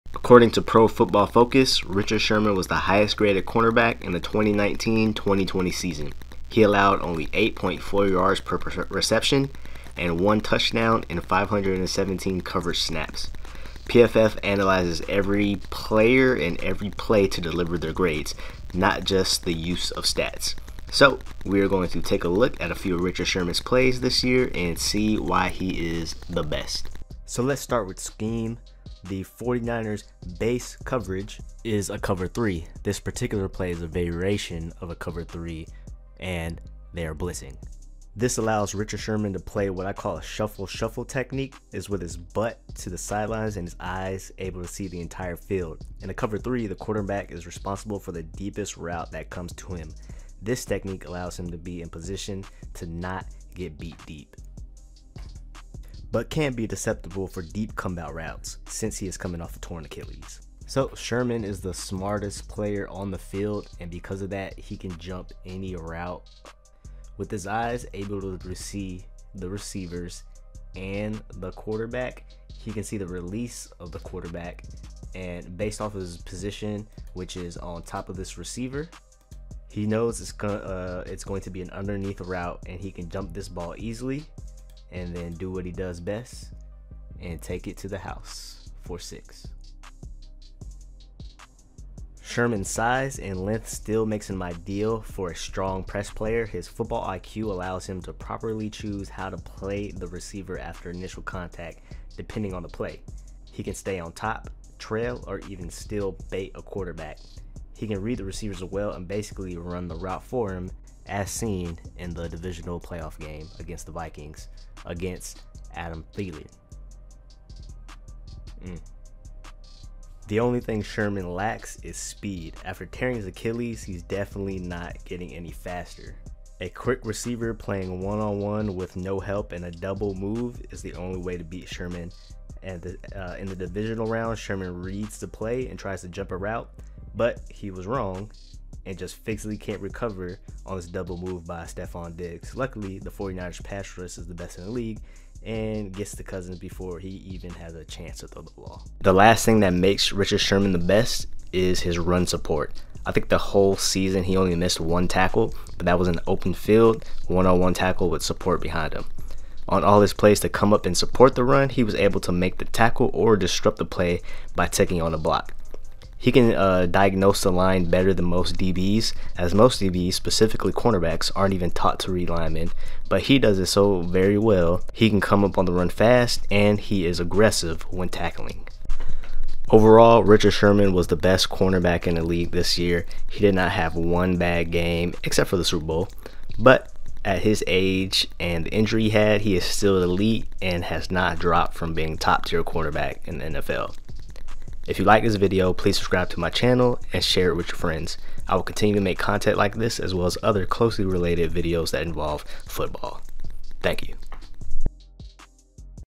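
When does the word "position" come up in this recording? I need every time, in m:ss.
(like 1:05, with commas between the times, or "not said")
0:51, 1:16.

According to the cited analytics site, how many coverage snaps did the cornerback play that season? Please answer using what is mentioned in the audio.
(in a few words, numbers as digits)
517.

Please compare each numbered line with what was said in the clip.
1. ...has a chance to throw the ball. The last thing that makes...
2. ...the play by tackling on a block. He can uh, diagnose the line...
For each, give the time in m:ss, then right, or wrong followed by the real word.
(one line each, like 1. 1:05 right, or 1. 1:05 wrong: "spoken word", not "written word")
1. 2:27 right
2. 2:43 wrong: "taking", not "tackling".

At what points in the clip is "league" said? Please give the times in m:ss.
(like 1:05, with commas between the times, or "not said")
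2:24, 3:02.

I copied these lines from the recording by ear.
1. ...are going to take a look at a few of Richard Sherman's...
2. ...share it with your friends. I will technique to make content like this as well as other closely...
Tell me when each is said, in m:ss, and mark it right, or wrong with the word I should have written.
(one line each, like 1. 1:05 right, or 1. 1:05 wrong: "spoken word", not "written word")
1. 0:21 right
2. 3:17 wrong: "continue", not "technique".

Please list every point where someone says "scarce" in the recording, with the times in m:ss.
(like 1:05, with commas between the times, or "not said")
not said.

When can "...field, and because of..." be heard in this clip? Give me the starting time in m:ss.
1:03.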